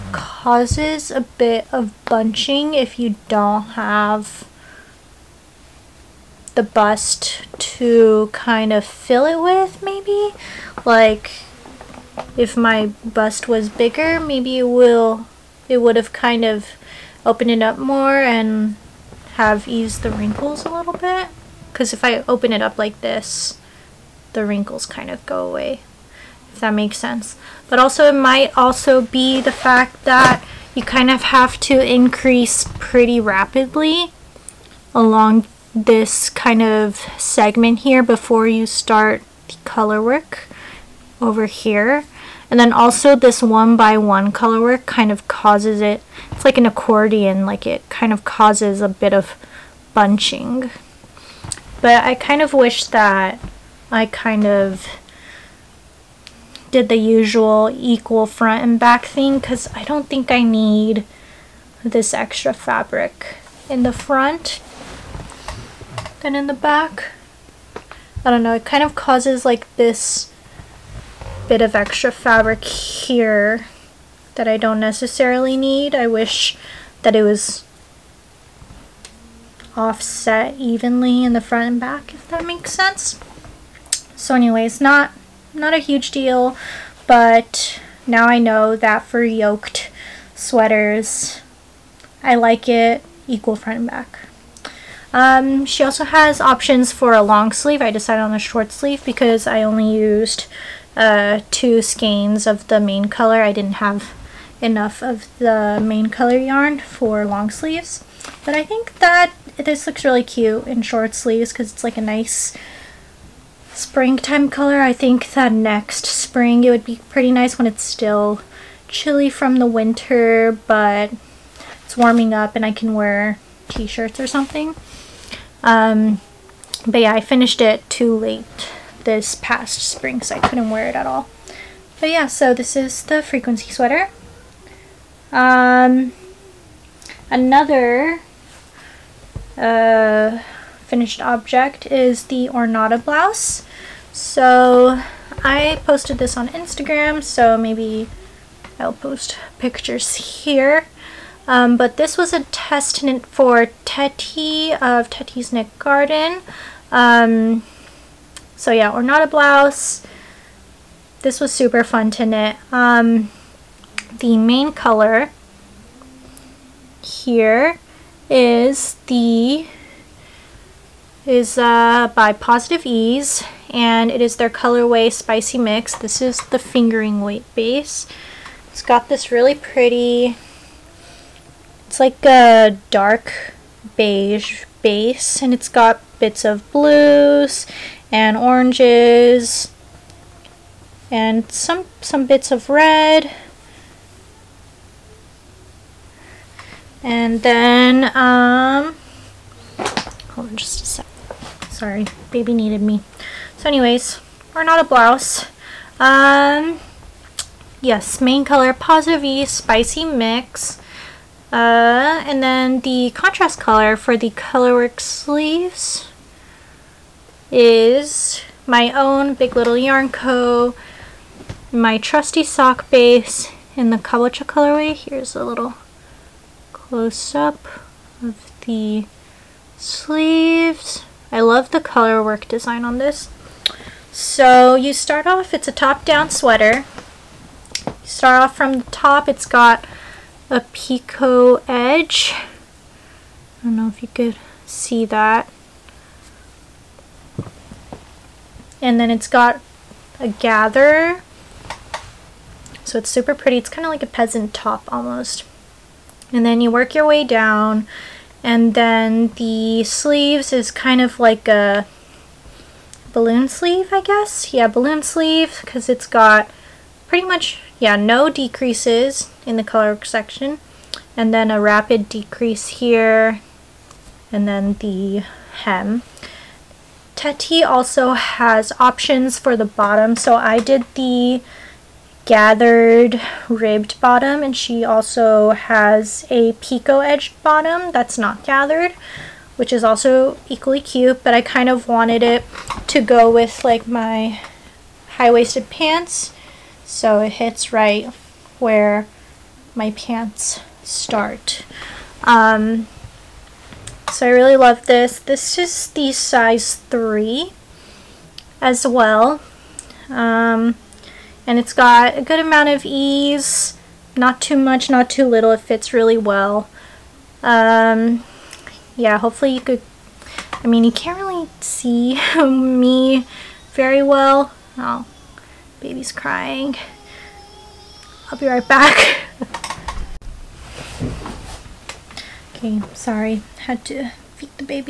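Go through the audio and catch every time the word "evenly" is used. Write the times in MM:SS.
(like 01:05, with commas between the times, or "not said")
01:20.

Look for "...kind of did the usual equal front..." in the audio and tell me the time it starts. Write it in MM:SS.
00:54.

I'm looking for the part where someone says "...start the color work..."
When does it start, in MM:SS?
00:38.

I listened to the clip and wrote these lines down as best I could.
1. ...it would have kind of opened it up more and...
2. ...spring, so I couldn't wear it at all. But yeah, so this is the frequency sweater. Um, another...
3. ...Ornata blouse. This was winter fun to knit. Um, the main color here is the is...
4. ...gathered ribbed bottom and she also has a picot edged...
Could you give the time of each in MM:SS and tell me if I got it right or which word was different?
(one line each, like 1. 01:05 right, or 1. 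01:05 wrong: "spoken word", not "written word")
1. 00:15 right
2. 02:09 right
3. 02:38 wrong: "super", not "winter"
4. 04:42 right.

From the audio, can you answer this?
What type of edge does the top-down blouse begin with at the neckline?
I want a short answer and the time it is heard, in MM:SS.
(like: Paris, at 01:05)
Picot edge, at 04:00.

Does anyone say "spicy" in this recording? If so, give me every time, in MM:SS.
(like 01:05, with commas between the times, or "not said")
02:55, 03:29.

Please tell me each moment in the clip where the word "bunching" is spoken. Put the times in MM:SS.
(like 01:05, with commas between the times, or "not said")
00:02, 00:49.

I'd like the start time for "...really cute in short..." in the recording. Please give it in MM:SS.
01:50.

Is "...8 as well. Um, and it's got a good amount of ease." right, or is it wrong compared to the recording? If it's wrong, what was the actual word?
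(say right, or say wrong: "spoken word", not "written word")
wrong: "3", not "8".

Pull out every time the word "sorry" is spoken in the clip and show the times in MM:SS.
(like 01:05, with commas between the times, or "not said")
03:21, 05:32.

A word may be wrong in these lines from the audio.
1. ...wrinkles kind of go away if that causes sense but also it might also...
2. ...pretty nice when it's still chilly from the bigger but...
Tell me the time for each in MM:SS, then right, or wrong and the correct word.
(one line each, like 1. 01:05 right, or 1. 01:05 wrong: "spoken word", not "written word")
1. 00:24 wrong: "makes", not "causes"
2. 01:57 wrong: "winter", not "bigger".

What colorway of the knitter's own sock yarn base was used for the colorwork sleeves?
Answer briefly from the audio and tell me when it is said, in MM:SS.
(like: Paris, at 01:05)
Kabocha, at 03:43.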